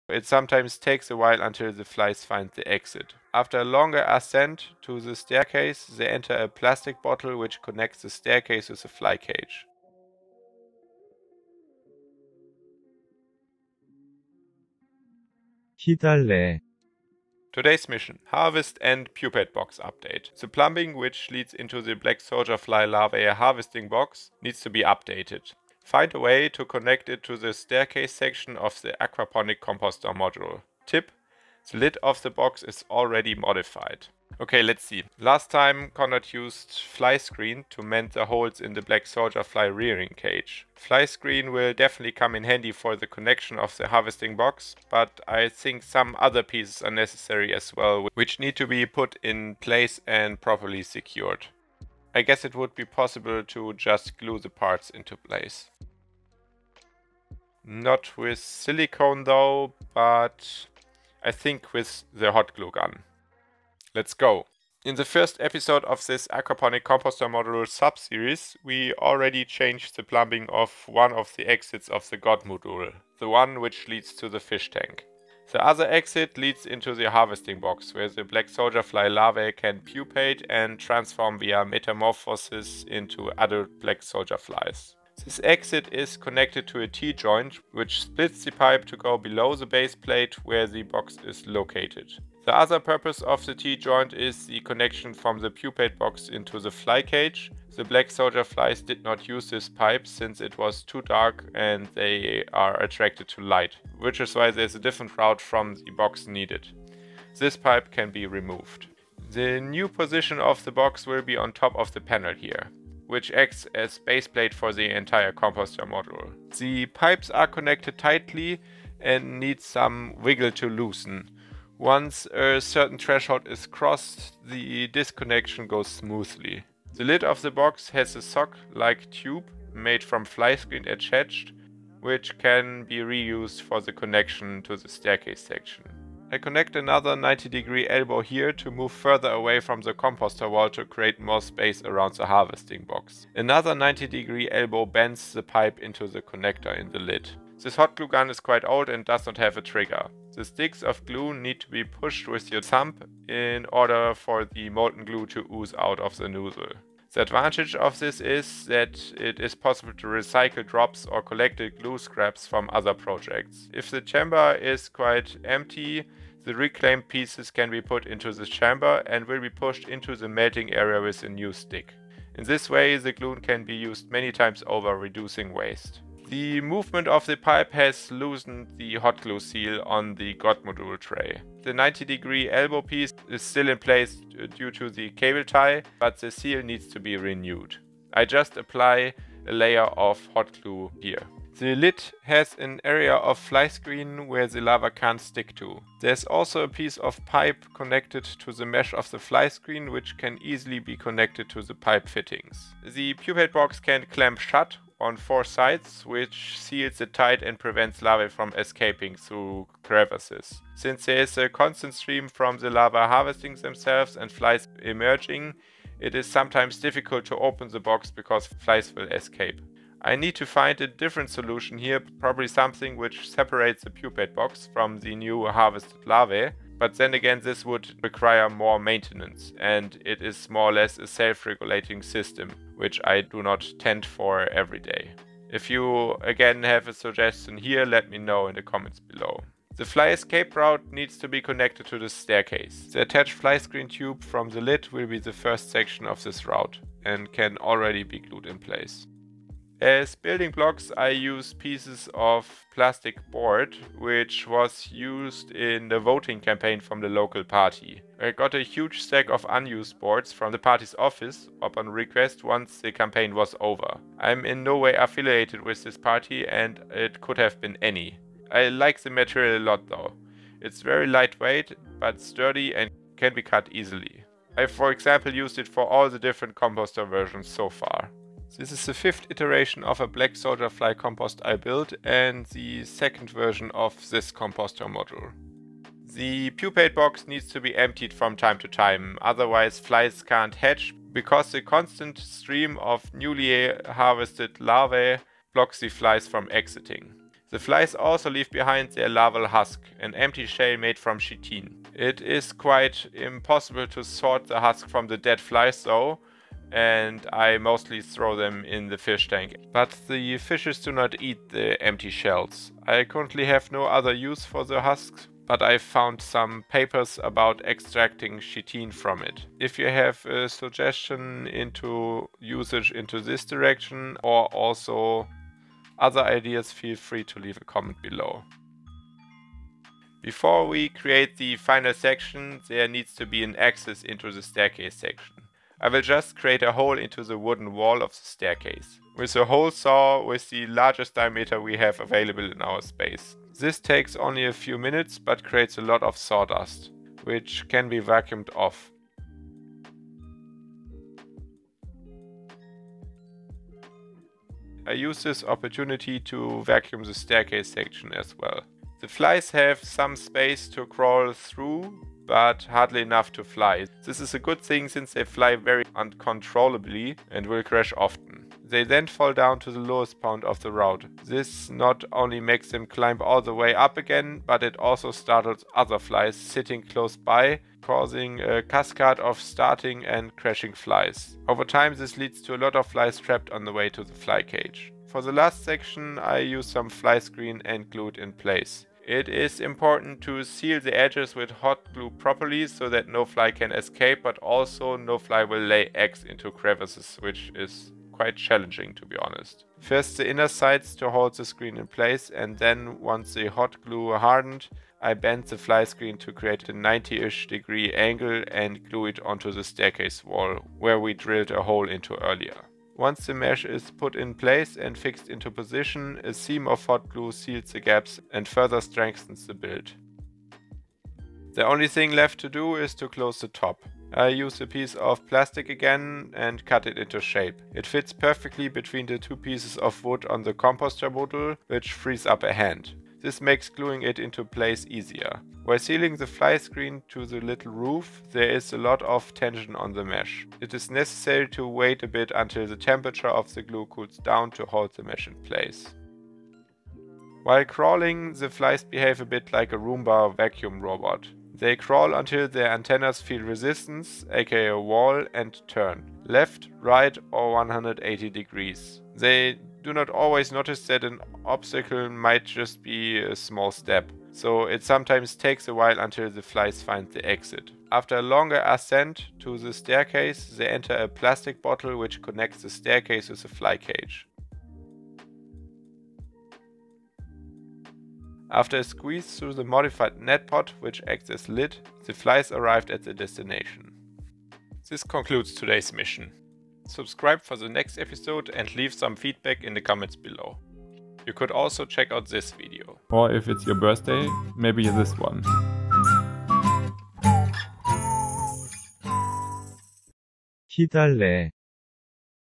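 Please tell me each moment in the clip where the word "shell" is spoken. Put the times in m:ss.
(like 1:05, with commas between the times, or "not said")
5:00, 5:12.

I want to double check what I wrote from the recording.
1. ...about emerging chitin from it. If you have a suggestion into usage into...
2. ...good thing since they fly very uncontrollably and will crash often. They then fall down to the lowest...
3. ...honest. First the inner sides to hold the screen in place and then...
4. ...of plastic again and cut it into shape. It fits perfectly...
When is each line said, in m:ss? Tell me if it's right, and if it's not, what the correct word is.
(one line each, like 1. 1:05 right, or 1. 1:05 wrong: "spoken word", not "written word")
1. 5:17 wrong: "extracting", not "emerging"
2. 6:04 right
3. 6:39 right
4. 7:04 right.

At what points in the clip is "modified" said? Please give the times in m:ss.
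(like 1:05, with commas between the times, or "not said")
0:33, 7:59.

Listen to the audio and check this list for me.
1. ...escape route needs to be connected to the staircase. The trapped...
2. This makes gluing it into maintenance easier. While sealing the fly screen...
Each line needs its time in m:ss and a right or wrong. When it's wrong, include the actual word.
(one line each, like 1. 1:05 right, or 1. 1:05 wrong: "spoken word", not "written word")
1. 4:00 wrong: "attached", not "trapped"
2. 7:13 wrong: "place", not "maintenance".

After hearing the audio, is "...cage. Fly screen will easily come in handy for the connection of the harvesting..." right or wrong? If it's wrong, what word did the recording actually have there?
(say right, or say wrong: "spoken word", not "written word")
wrong: "definitely", not "easily".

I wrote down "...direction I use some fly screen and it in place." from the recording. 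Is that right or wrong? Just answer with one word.
wrong.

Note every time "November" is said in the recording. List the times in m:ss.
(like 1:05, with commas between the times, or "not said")
not said.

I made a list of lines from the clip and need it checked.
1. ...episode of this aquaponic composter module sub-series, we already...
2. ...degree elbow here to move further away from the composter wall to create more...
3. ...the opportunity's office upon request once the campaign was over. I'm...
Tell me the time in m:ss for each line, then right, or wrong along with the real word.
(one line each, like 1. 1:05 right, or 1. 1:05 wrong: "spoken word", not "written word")
1. 1:05 right
2. 2:17 right
3. 4:20 wrong: "party", not "opportunity".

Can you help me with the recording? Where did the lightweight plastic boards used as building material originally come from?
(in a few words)
voting campaign.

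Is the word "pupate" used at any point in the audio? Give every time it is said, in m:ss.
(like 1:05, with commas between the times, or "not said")
0:19, 1:19, 1:35, 3:23, 3:43, 4:46.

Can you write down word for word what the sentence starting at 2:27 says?
This hot glue gun is quite old and does not have a trigger.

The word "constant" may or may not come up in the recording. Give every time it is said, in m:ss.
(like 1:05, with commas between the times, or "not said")
3:31, 4:51.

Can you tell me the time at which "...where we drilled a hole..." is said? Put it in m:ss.
6:50.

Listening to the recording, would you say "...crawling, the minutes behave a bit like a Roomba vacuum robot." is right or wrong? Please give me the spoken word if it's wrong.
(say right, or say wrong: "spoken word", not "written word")
wrong: "flies", not "minutes".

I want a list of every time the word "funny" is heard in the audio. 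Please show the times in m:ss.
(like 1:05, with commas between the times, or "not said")
not said.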